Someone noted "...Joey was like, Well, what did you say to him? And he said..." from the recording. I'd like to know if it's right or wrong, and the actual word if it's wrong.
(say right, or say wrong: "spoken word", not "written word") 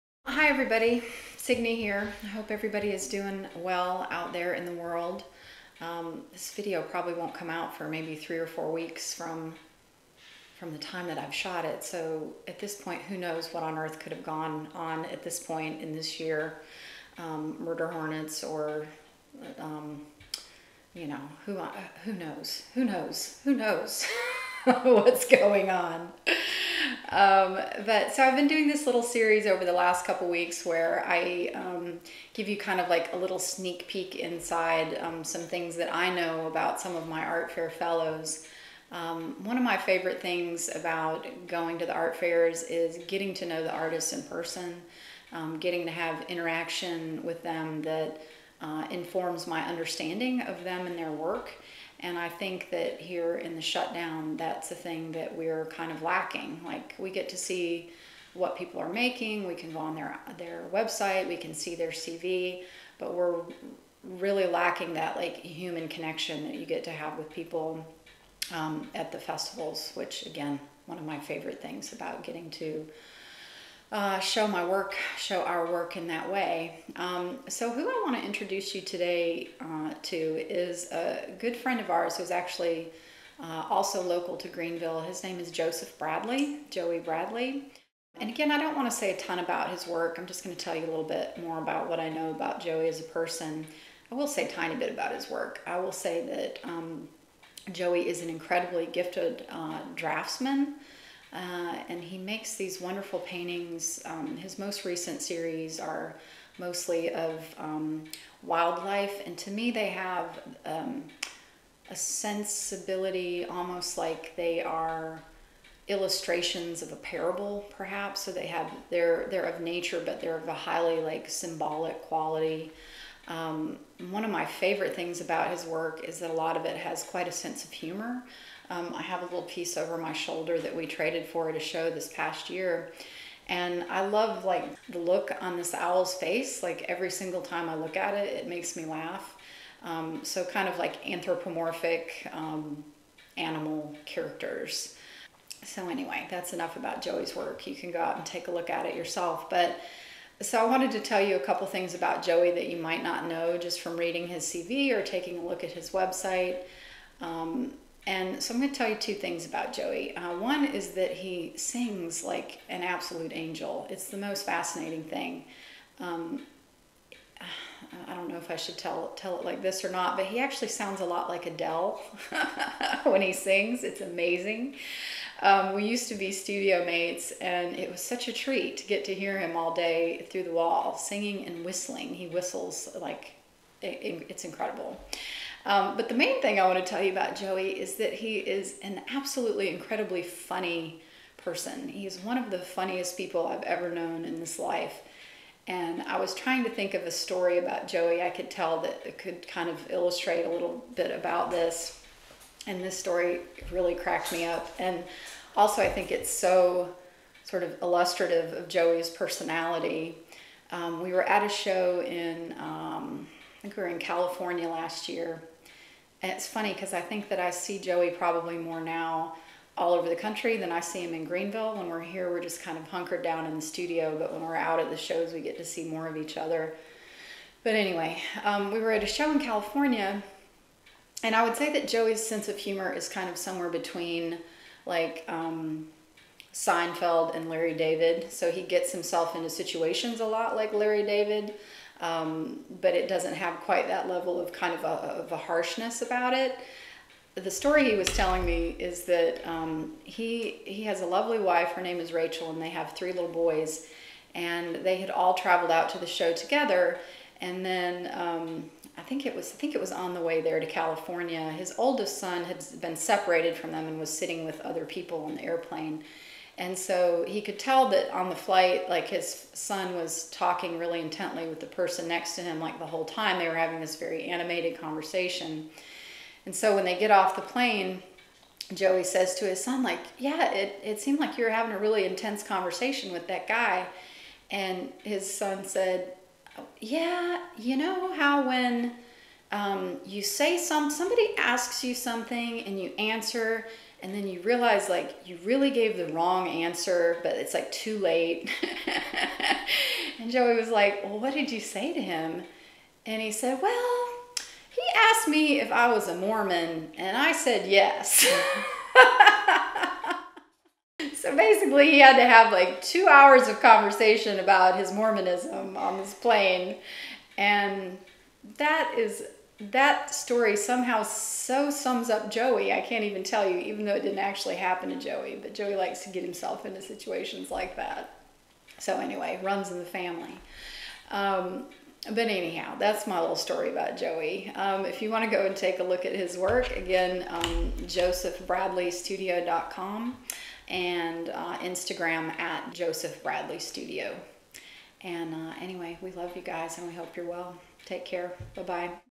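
right.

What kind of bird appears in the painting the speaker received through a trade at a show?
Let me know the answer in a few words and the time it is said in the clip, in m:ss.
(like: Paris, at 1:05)
Owl, at 2:15.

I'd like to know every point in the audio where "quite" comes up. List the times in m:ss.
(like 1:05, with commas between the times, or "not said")
2:07, 4:03.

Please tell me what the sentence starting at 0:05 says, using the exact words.
Um, this video probably won't come out for maybe three or four weeks from, from the time that I've shot it.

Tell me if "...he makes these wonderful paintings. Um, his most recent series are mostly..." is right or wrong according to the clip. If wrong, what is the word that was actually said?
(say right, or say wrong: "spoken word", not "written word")
right.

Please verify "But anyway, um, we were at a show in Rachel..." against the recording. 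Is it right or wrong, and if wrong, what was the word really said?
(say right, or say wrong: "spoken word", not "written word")
wrong: "California", not "Rachel".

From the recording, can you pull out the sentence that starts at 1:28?
And again, I don't want to say a ton about his work.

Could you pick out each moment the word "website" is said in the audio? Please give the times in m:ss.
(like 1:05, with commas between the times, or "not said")
1:00, 2:35.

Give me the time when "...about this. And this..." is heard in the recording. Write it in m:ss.
3:21.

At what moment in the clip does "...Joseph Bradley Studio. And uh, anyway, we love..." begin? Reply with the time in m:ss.
5:42.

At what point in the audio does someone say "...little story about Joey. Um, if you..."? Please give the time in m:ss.
5:33.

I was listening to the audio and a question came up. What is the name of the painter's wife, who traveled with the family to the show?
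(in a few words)
Rachel.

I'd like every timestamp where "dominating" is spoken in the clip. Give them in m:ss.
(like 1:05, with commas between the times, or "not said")
not said.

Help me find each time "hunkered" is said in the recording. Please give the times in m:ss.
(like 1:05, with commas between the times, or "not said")
3:42.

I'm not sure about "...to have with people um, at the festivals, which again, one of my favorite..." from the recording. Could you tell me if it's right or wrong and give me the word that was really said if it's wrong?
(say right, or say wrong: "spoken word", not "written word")
right.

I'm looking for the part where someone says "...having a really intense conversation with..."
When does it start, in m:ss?
4:41.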